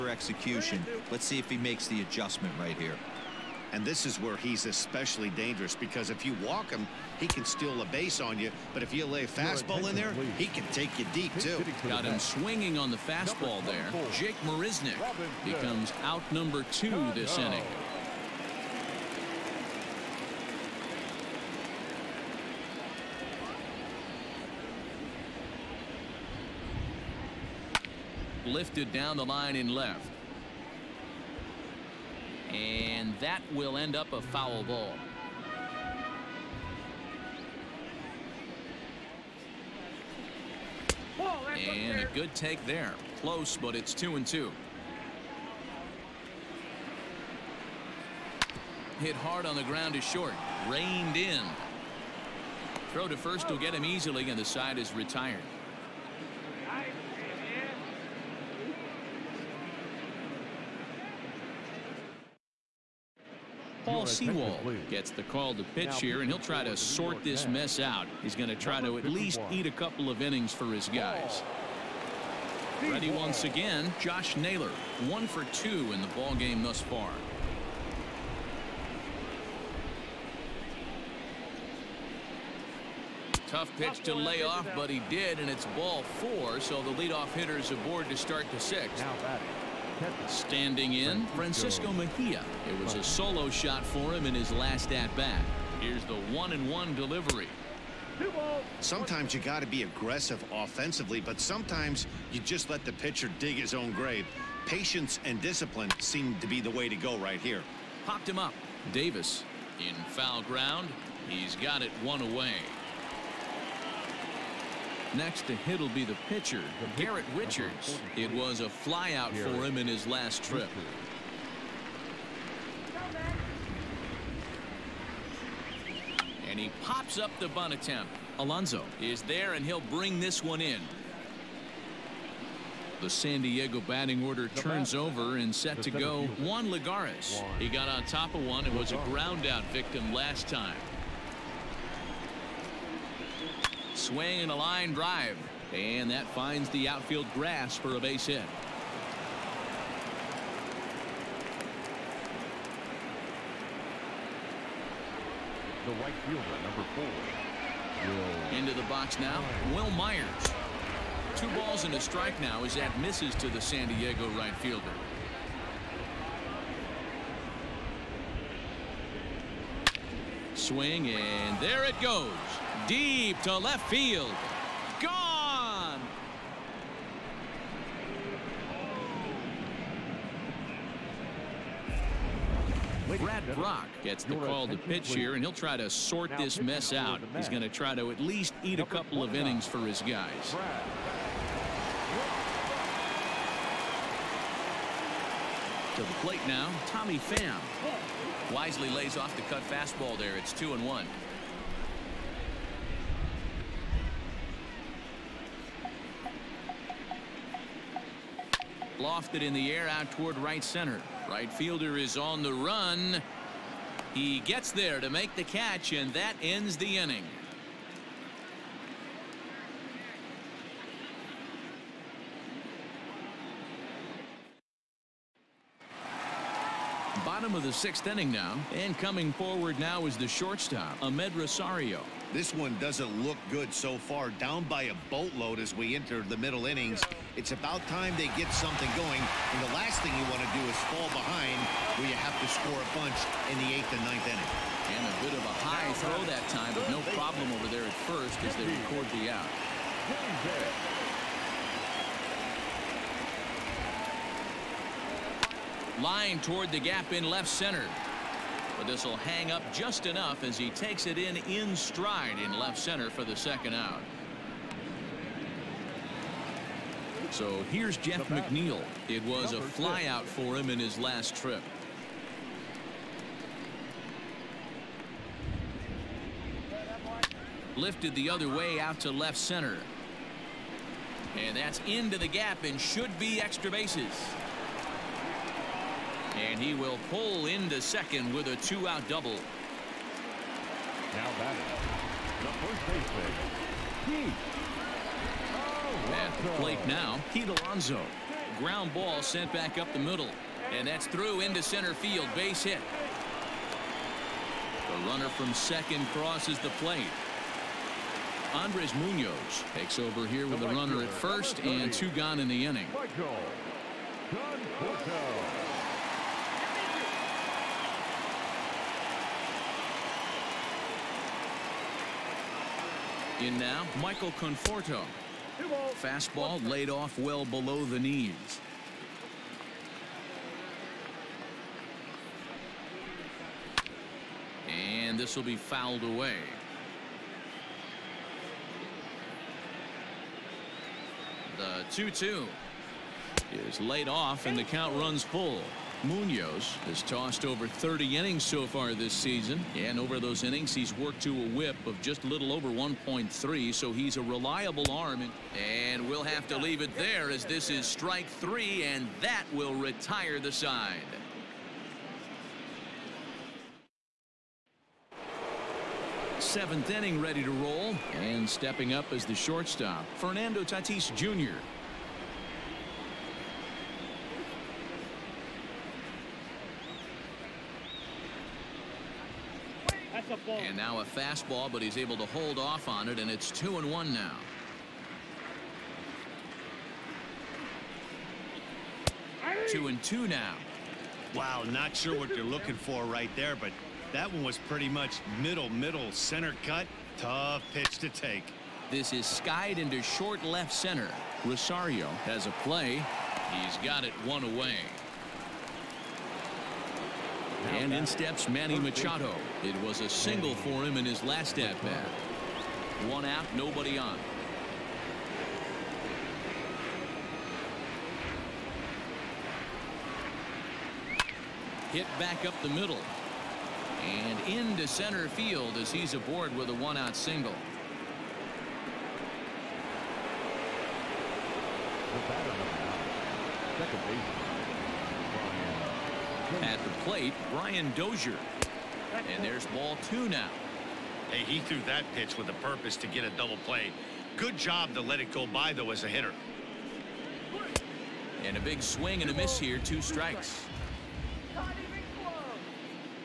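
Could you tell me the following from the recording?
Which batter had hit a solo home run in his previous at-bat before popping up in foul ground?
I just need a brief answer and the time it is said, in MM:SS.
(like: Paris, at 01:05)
Francisco Mejia, at 01:31.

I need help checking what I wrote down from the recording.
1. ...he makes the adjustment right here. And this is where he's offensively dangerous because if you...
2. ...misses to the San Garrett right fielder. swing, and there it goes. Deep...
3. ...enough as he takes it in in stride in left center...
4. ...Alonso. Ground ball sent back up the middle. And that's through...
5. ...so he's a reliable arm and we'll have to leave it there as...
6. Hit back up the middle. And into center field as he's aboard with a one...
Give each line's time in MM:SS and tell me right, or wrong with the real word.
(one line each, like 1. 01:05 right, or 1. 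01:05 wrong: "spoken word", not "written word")
1. 00:01 wrong: "especially", not "offensively"
2. 02:42 wrong: "Diego", not "Garrett"
3. 04:20 right
4. 04:57 right
5. 05:53 right
6. 07:01 right.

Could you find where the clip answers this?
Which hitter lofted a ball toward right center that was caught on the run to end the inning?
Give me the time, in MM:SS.
03:16.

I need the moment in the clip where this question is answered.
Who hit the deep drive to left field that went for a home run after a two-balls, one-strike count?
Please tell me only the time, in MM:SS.
02:39.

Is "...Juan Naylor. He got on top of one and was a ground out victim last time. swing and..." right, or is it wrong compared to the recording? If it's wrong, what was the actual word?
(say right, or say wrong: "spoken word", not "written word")
wrong: "Lagares", not "Naylor".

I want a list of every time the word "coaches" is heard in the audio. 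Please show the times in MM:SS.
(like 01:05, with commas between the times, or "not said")
not said.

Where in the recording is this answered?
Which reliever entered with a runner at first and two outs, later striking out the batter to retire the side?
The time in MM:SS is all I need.
05:08.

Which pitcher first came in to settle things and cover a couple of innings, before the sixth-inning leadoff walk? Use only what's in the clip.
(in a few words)
Paul Sewald.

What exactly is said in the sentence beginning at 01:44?
Patience and discipline seem to be the way to go right here.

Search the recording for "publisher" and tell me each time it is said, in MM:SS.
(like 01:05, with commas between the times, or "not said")
not said.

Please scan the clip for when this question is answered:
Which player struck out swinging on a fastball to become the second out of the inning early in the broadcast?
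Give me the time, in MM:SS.
00:14.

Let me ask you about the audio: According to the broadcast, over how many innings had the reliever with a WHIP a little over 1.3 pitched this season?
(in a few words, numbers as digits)
over 30.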